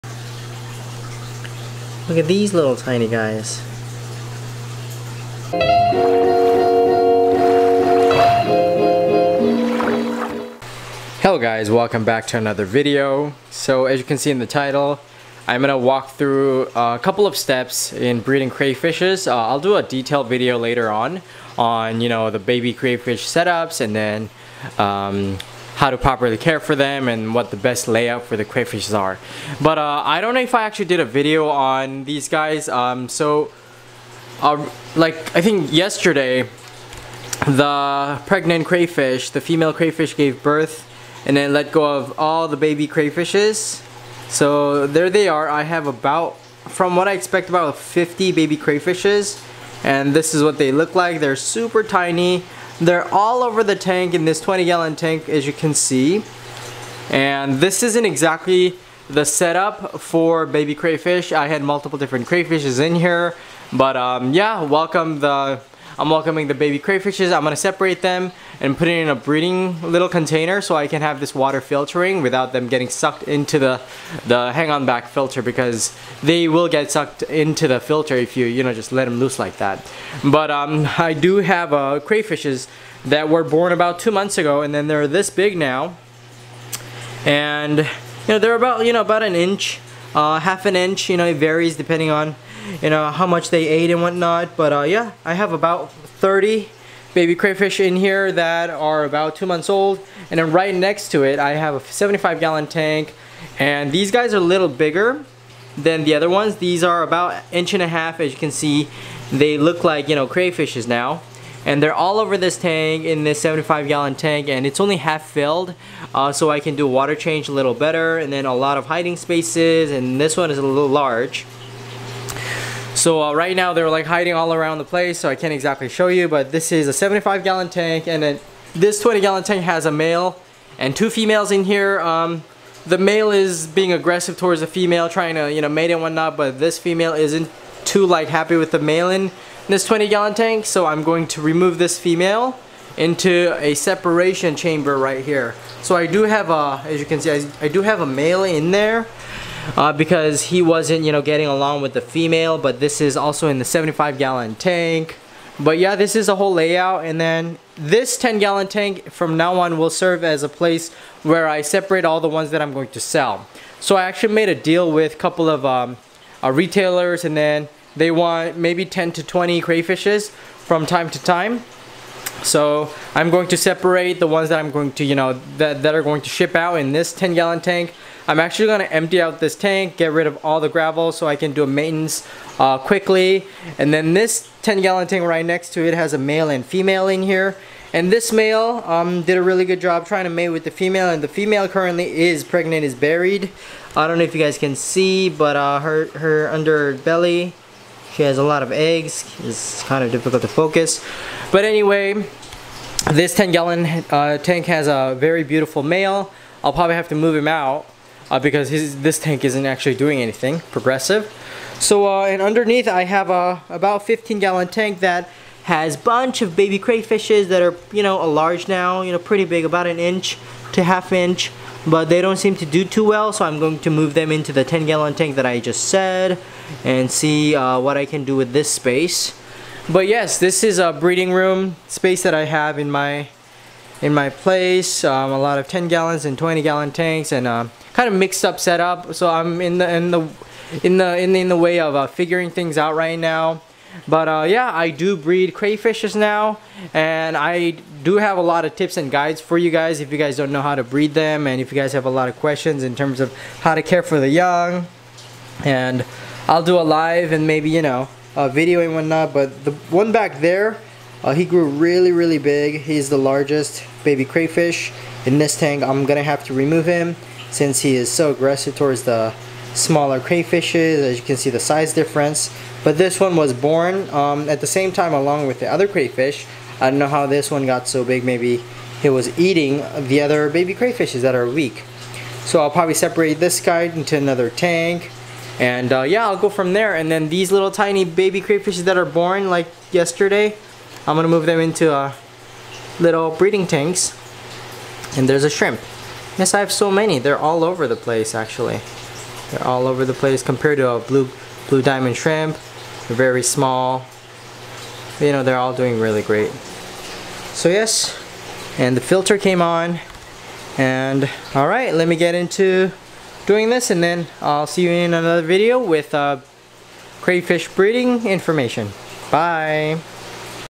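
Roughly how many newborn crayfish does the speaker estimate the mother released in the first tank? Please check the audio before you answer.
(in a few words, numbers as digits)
50.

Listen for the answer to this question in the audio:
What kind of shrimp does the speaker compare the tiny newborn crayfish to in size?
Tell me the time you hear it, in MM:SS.
05:01.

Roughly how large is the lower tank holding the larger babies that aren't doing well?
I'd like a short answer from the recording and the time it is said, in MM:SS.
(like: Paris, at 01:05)
15 gallons, at 03:34.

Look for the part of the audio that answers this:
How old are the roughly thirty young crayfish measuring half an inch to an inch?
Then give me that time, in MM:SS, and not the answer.
01:39.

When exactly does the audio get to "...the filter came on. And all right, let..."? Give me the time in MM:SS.
05:08.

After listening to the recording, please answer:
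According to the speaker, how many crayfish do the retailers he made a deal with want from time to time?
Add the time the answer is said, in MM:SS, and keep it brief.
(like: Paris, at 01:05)
10 to 20, at 02:48.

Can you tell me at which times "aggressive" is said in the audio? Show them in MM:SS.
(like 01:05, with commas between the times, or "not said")
02:13, 04:28.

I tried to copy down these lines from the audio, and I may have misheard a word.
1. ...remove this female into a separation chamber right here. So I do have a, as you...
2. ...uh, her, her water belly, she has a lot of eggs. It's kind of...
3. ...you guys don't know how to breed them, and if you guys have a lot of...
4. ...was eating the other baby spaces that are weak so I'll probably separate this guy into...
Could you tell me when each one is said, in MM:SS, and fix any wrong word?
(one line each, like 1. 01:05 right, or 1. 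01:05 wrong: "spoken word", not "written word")
1. 02:21 right
2. 03:15 wrong: "under", not "water"
3. 04:10 right
4. 04:39 wrong: "crayfishes", not "spaces".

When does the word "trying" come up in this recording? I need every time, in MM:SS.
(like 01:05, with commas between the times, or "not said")
02:15, 03:10.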